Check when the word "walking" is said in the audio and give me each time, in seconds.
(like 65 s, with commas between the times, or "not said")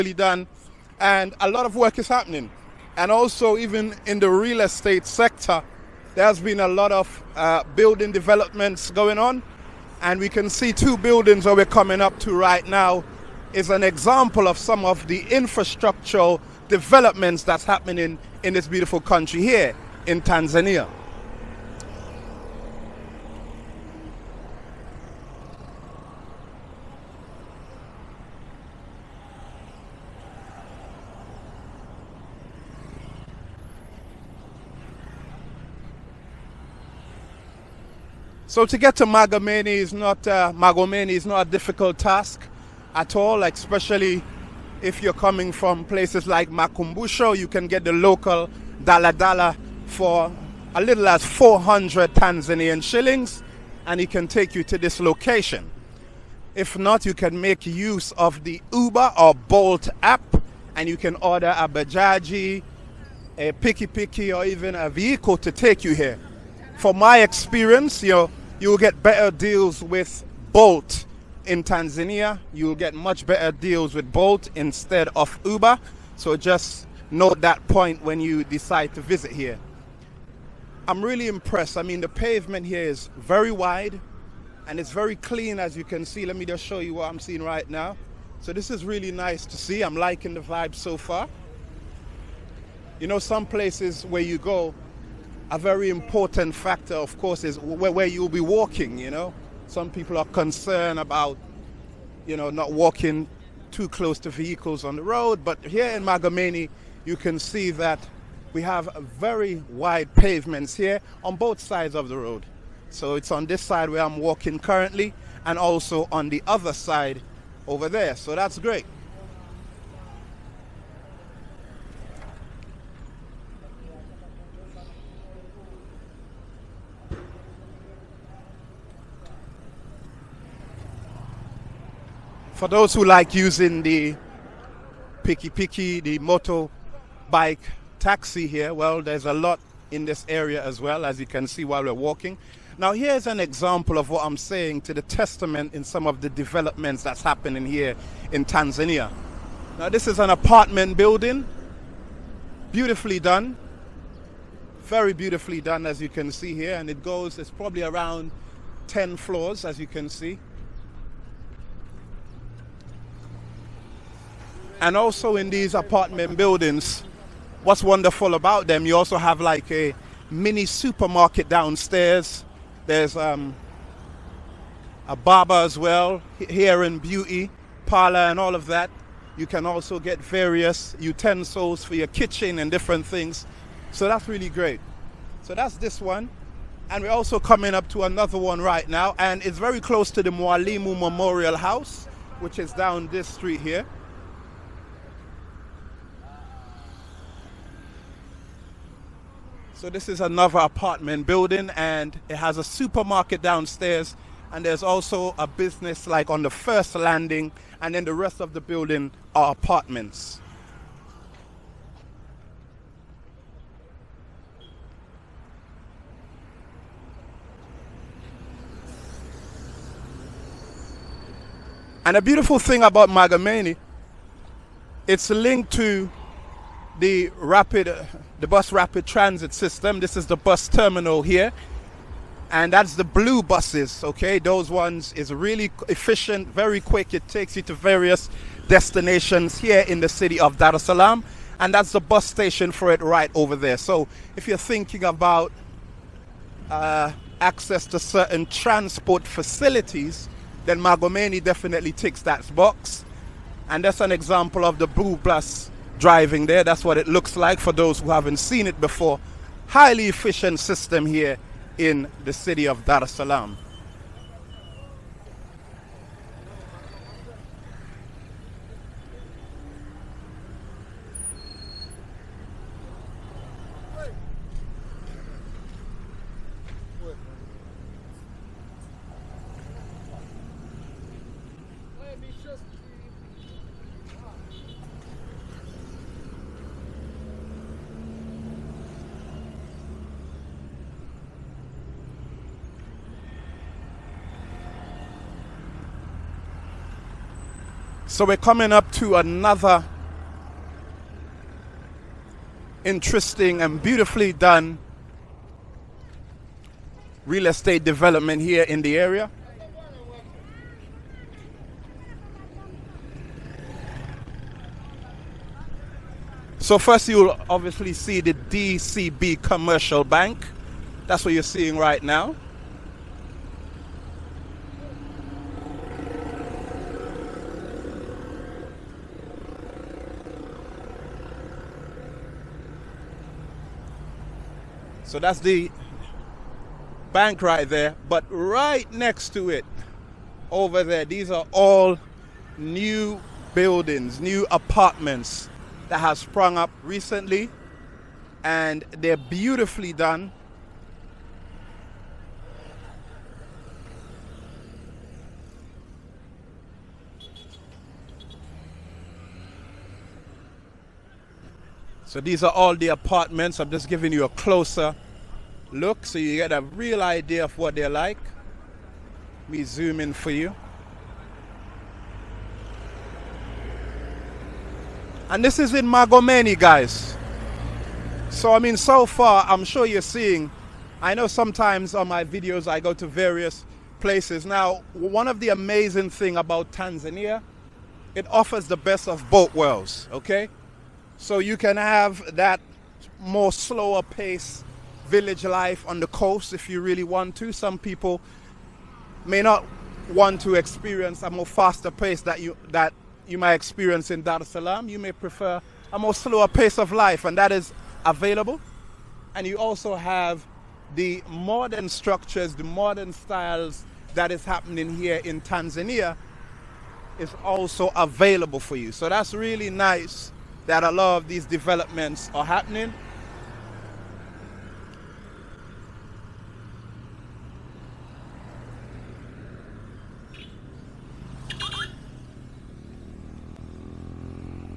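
98 s, 102 s, 114 s, 141 s.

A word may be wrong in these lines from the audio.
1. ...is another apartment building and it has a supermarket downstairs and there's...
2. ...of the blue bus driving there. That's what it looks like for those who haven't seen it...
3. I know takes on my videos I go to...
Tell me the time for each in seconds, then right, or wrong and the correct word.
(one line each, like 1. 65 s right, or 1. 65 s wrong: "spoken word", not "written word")
1. 200 s right
2. 254 s right
3. 381 s wrong: "sometimes", not "takes".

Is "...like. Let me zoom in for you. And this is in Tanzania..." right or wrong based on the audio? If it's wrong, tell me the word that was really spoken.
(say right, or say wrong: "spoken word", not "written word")
wrong: "Magomeni", not "Tanzania".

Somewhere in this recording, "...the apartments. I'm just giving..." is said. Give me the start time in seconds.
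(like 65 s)
362 s.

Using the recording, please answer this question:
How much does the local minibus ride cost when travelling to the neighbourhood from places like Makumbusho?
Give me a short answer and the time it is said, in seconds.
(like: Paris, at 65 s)
400 Tanzanian shillings, at 51 s.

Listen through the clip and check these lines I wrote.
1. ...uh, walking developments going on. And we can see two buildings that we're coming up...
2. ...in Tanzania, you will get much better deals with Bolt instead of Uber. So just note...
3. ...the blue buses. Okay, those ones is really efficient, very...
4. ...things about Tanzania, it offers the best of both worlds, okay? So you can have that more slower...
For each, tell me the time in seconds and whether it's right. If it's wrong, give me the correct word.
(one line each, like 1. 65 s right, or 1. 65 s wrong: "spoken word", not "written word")
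1. 7 s wrong: "building", not "walking"
2. 71 s right
3. 232 s right
4. 386 s right.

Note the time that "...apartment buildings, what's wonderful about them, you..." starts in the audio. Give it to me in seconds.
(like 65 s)
165 s.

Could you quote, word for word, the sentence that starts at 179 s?
You can also get various utensils for your kitchen and different things.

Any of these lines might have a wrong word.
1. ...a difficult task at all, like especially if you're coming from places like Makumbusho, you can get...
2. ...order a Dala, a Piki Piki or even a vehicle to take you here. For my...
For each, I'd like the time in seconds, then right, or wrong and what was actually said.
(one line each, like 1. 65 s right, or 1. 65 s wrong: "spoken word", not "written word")
1. 41 s right
2. 61 s wrong: "Bajaji", not "Dala".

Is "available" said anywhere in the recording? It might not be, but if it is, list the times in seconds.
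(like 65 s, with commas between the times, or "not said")
408 s, 417 s.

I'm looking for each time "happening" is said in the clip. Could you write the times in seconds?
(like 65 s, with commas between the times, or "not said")
2 s, 17 s, 147 s, 414 s, 422 s.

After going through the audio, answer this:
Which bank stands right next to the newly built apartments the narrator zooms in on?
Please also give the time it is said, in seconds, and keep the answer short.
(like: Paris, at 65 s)
DCB Commercial Bank, at 318 s.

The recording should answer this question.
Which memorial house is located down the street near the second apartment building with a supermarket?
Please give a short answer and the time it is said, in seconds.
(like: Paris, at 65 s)
Mwalimu Memorial House, at 190 s.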